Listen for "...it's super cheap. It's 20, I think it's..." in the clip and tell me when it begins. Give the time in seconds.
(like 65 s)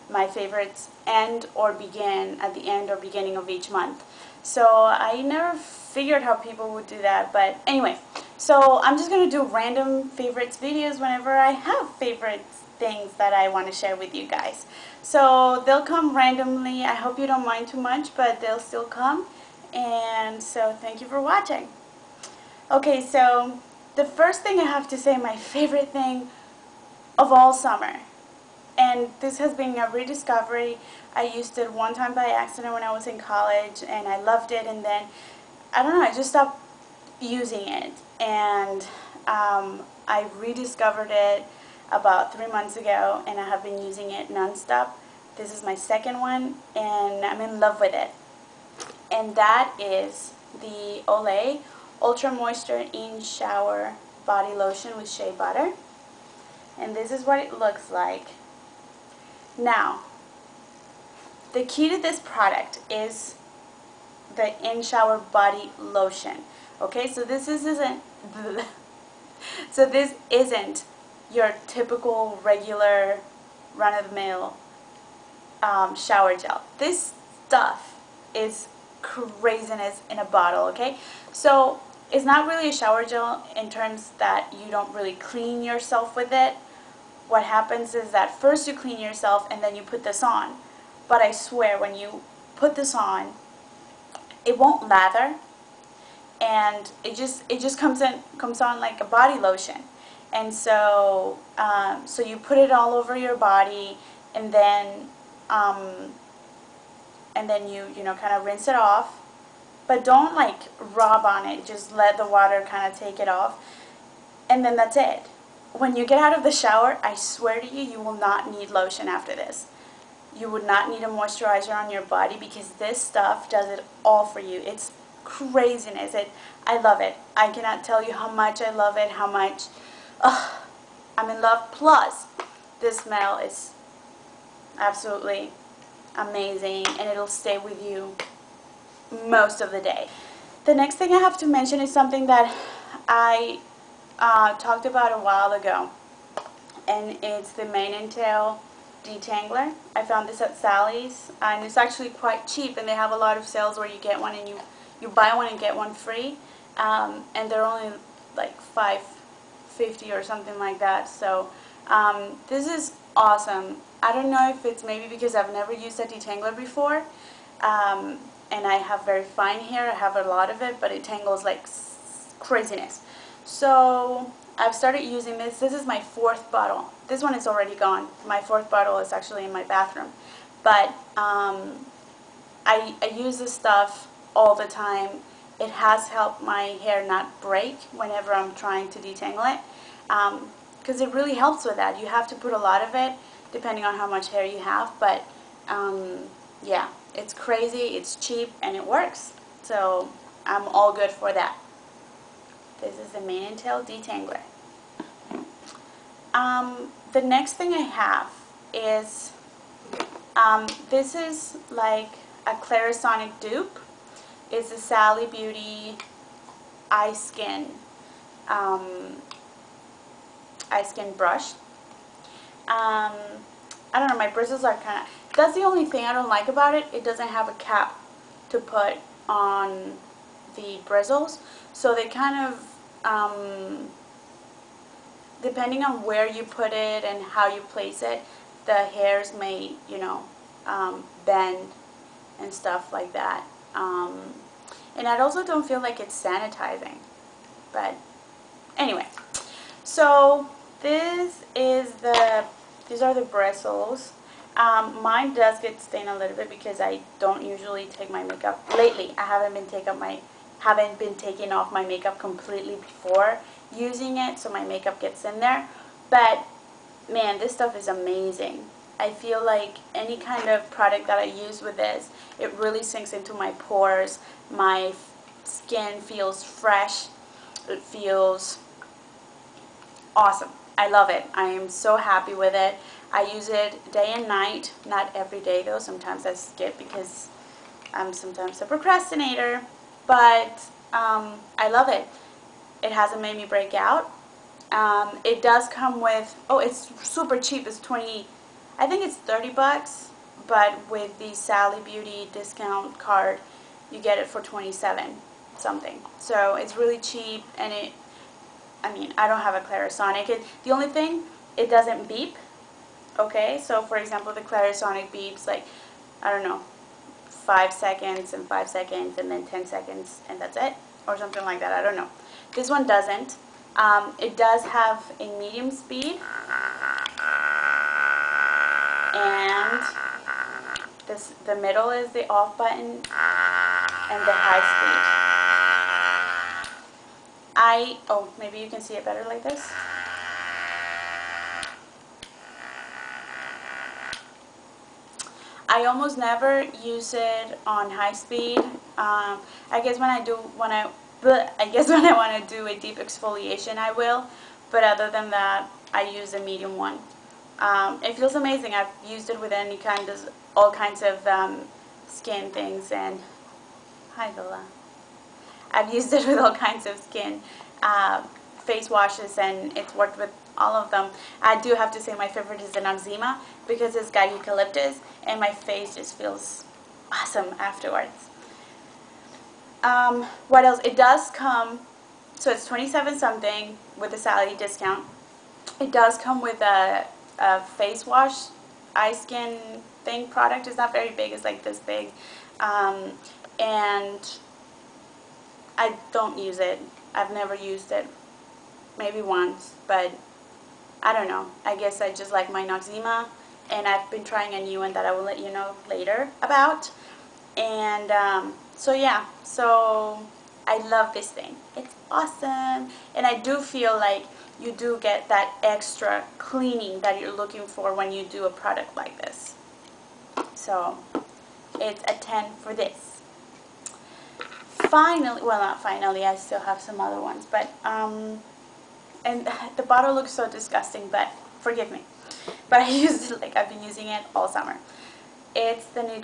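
296 s.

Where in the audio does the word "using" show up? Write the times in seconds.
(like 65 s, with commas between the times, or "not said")
37 s, 43 s, 175 s, 263 s, 433 s.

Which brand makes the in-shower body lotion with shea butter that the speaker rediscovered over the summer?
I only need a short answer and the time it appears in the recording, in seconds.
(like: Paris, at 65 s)
Olay, at 51 s.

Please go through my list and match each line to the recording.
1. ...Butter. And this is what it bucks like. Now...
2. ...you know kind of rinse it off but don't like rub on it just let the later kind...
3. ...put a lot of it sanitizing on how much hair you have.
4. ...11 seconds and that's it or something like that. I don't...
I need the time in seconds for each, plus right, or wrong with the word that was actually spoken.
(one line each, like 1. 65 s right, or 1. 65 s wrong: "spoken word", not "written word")
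1. 55 s wrong: "looks", not "bucks"
2. 107 s wrong: "water", not "later"
3. 192 s wrong: "depending", not "sanitizing"
4. 319 s wrong: "10", not "11".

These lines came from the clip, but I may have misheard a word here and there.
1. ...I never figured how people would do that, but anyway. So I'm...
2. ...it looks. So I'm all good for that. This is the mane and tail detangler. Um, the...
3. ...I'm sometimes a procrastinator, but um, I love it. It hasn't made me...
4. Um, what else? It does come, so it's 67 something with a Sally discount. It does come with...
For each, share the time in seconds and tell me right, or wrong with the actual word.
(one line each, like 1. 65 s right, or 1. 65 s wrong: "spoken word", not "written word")
1. 4 s right
2. 198 s wrong: "works", not "looks"
3. 287 s right
4. 379 s wrong: "27", not "67".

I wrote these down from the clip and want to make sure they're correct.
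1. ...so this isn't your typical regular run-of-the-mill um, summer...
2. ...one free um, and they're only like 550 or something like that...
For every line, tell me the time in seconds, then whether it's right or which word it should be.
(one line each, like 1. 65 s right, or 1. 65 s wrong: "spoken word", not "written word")
1. 69 s wrong: "shower", not "summer"
2. 155 s right.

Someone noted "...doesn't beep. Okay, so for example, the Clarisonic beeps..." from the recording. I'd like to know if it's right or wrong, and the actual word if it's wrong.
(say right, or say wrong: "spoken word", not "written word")
right.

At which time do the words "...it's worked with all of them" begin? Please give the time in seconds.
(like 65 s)
369 s.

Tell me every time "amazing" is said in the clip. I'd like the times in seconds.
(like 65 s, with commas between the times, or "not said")
136 s, 267 s, 358 s.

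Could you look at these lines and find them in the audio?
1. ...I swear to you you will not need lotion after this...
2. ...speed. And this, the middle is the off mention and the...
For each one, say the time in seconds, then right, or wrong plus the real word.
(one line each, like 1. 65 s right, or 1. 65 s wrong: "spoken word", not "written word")
1. 117 s right
2. 325 s wrong: "button", not "mention".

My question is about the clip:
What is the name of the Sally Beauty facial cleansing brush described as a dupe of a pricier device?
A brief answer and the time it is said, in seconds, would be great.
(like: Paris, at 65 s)
Iskin Brush, at 220 s.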